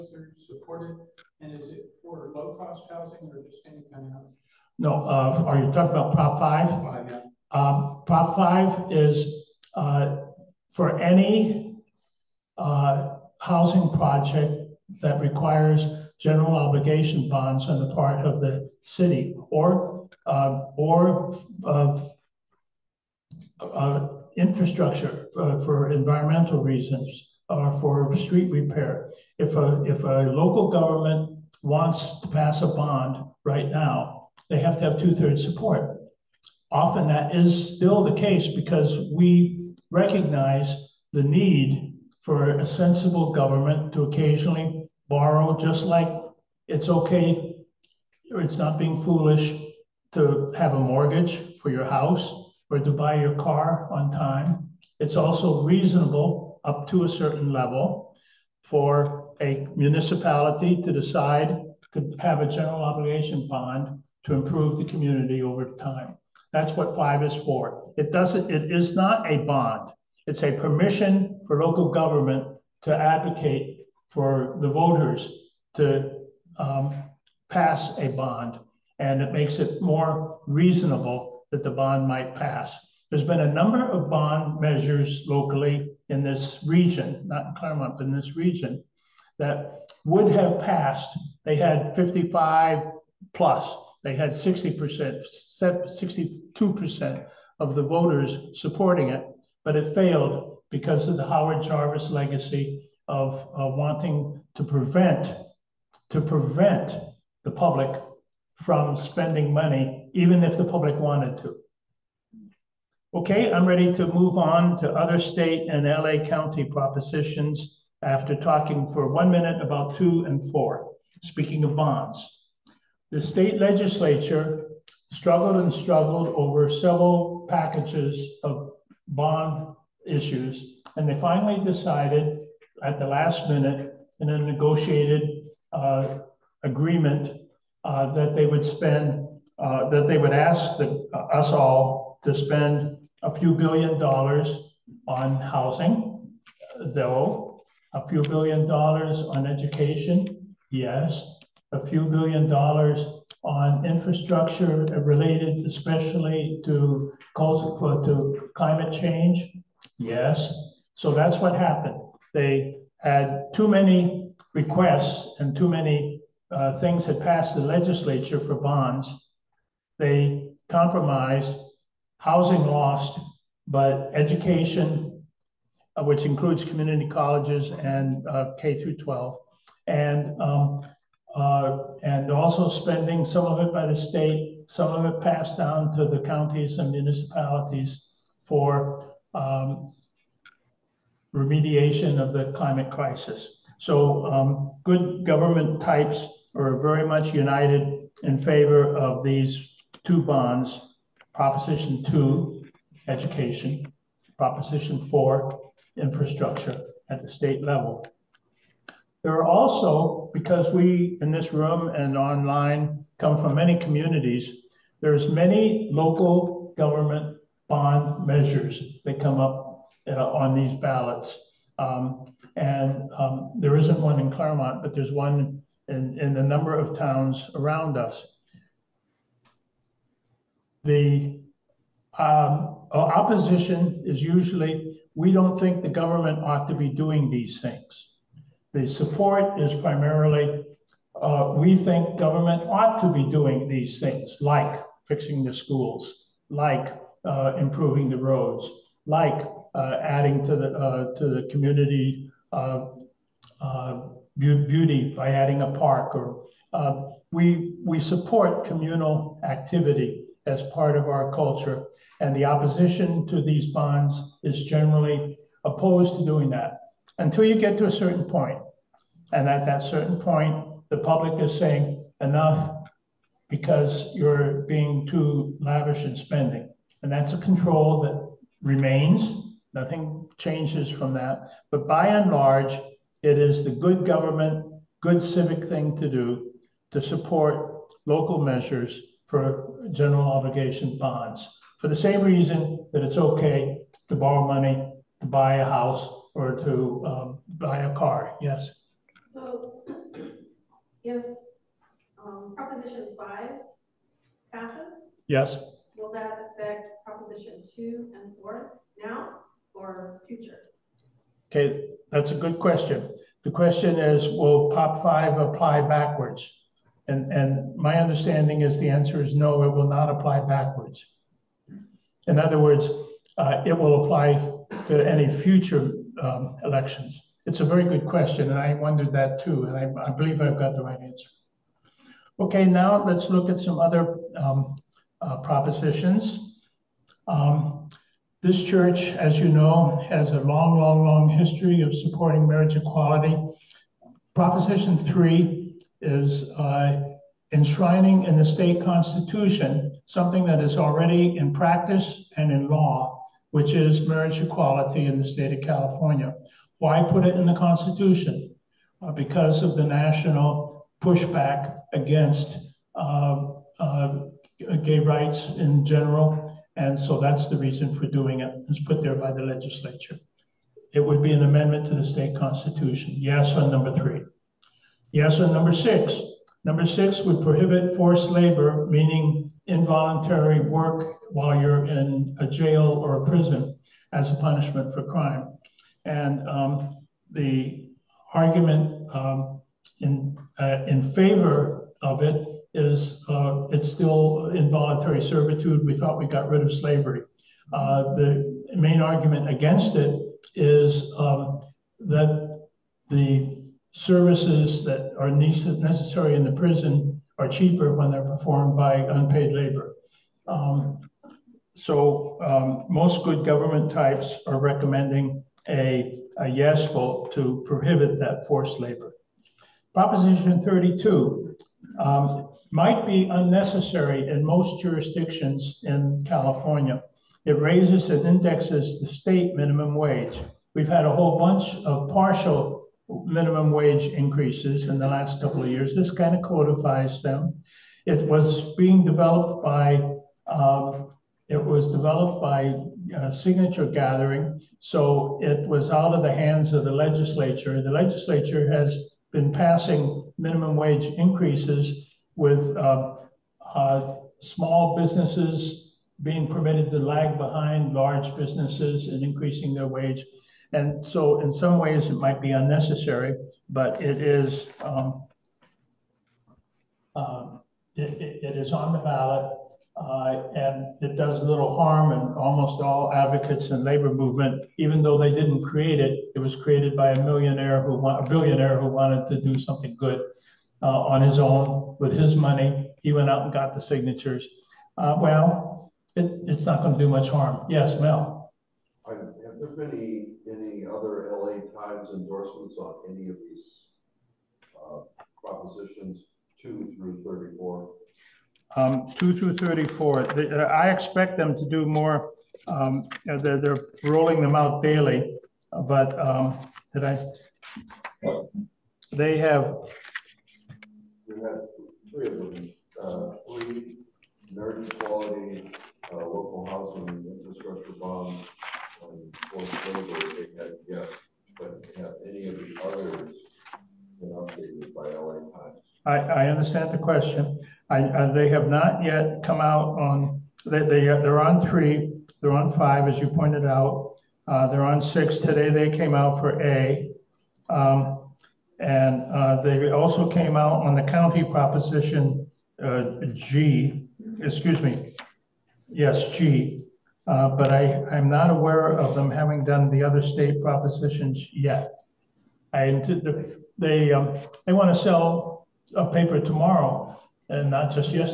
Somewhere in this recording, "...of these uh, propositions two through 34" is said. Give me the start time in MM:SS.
08:13.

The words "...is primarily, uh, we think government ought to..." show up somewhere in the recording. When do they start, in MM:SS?
03:59.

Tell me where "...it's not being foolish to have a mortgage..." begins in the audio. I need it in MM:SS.
00:48.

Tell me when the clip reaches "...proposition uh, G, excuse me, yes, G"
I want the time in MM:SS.
09:01.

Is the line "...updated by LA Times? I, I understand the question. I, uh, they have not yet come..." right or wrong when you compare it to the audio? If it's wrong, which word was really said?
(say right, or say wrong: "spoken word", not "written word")
right.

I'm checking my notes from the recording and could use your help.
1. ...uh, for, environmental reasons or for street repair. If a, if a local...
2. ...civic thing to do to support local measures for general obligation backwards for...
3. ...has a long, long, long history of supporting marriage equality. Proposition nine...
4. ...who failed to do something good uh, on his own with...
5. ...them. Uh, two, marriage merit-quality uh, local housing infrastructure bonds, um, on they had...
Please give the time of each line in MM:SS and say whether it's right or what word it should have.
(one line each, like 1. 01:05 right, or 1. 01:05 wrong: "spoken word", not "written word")
1. 00:25 right
2. 04:45 wrong: "bonds", not "backwards"
3. 05:40 wrong: "three", not "nine"
4. 07:58 wrong: "wanted", not "failed"
5. 08:32 wrong: "three", not "two".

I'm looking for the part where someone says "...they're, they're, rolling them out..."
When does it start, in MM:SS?
08:23.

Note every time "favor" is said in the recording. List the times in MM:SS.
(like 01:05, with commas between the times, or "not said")
03:18, 06:31.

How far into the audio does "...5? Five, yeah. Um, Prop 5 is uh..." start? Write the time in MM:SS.
00:06.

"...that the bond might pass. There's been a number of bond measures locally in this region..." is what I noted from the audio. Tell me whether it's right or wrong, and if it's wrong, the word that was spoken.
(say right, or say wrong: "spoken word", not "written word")
right.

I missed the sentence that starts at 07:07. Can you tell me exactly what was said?
It raises and indexes the state minimum wage.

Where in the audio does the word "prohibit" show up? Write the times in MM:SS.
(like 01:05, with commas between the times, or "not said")
06:17, 06:57.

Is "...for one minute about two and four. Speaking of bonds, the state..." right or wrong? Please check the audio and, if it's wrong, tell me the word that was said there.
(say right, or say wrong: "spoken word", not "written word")
right.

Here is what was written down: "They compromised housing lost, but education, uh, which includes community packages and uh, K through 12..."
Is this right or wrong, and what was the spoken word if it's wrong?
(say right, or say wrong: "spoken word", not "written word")
wrong: "colleges", not "packages".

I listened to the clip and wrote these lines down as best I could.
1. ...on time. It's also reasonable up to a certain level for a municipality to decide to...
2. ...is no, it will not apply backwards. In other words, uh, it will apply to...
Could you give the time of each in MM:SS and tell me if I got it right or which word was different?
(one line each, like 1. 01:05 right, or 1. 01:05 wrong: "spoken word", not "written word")
1. 00:53 right
2. 05:19 right.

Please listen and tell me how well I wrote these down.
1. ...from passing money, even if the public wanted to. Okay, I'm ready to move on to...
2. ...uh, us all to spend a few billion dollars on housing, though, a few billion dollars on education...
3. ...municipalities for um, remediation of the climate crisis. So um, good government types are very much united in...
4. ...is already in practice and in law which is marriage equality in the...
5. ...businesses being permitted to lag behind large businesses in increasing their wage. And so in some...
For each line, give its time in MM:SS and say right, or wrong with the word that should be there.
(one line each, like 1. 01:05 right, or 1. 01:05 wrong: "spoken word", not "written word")
1. 01:48 wrong: "spending", not "passing"
2. 02:21 right
3. 03:06 right
4. 05:50 right
5. 07:35 right.